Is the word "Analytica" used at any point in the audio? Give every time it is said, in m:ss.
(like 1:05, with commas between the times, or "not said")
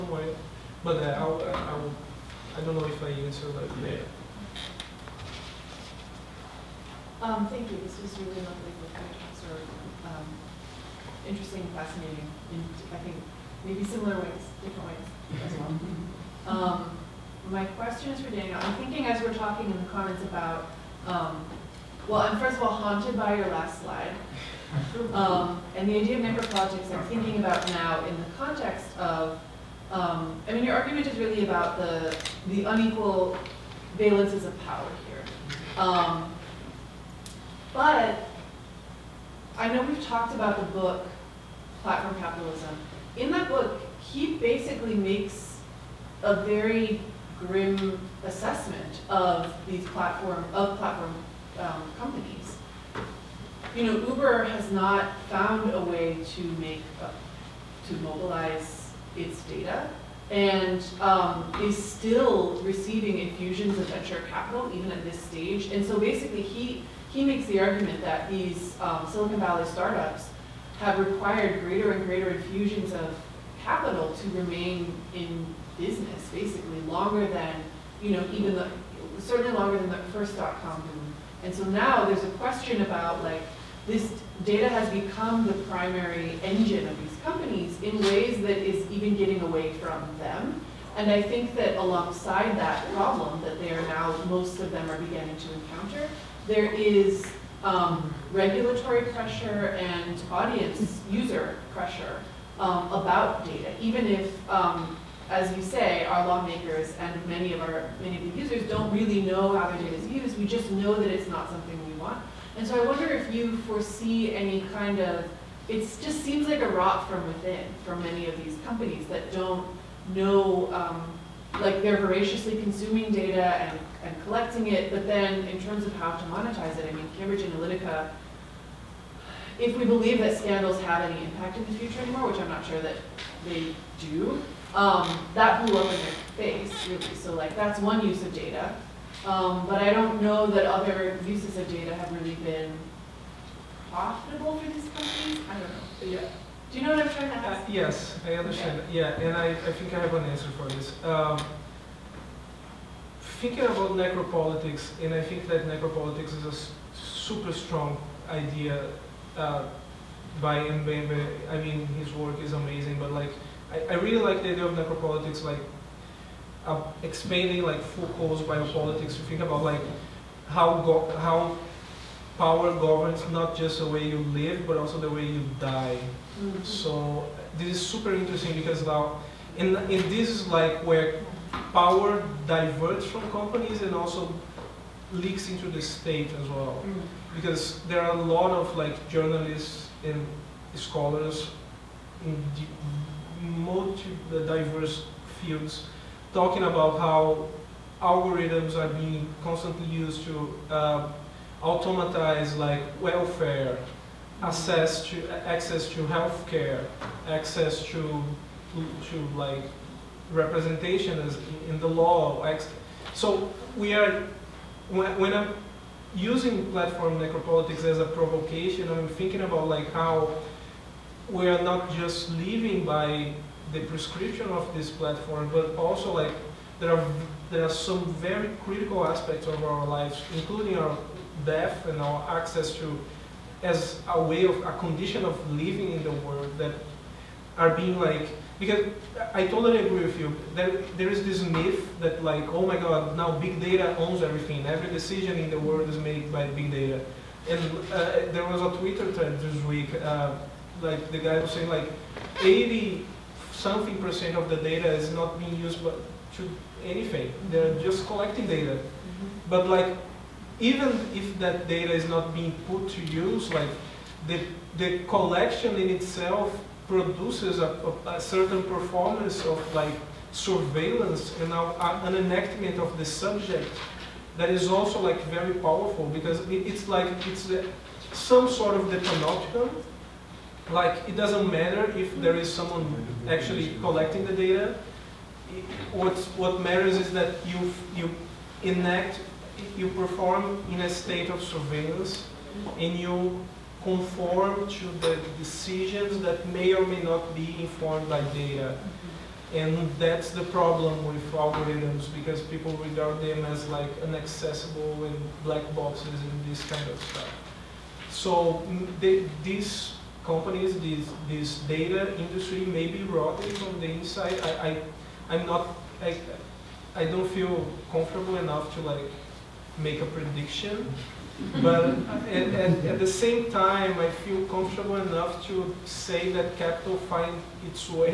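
2:07.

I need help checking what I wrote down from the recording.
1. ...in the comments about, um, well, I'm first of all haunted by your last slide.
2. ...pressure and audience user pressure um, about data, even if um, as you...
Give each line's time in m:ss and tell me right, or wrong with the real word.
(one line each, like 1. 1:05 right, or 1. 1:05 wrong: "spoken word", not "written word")
1. 0:19 right
2. 1:39 right.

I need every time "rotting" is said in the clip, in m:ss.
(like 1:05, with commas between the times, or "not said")
5:13.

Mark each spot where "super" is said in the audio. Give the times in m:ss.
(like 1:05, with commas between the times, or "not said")
2:36, 2:57.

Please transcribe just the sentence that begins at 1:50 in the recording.
We just know that it's not something we want.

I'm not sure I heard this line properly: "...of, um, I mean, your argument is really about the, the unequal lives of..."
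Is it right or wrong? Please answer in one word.
wrong.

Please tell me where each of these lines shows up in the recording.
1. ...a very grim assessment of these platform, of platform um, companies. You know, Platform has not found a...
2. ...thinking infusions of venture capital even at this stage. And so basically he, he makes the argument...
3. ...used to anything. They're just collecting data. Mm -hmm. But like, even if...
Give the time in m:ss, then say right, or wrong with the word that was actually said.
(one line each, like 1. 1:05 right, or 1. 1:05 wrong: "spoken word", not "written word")
1. 0:46 wrong: "Uber", not "Platform"
2. 1:02 wrong: "receiving", not "thinking"
3. 4:15 right.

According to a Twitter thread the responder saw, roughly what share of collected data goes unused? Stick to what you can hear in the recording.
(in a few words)
80-something percent.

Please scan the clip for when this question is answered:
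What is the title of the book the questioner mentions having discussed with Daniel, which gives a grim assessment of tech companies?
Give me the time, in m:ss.
0:41.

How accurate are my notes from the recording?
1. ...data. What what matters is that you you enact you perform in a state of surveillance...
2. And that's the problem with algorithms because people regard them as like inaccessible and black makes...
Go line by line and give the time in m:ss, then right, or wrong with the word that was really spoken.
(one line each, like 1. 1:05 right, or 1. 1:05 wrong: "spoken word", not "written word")
1. 4:44 right
2. 4:59 wrong: "boxes", not "makes".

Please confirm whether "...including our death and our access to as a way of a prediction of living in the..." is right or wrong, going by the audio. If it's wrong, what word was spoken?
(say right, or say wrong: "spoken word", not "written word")
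wrong: "condition", not "prediction".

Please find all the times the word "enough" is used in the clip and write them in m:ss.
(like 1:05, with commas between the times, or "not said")
5:18, 5:24.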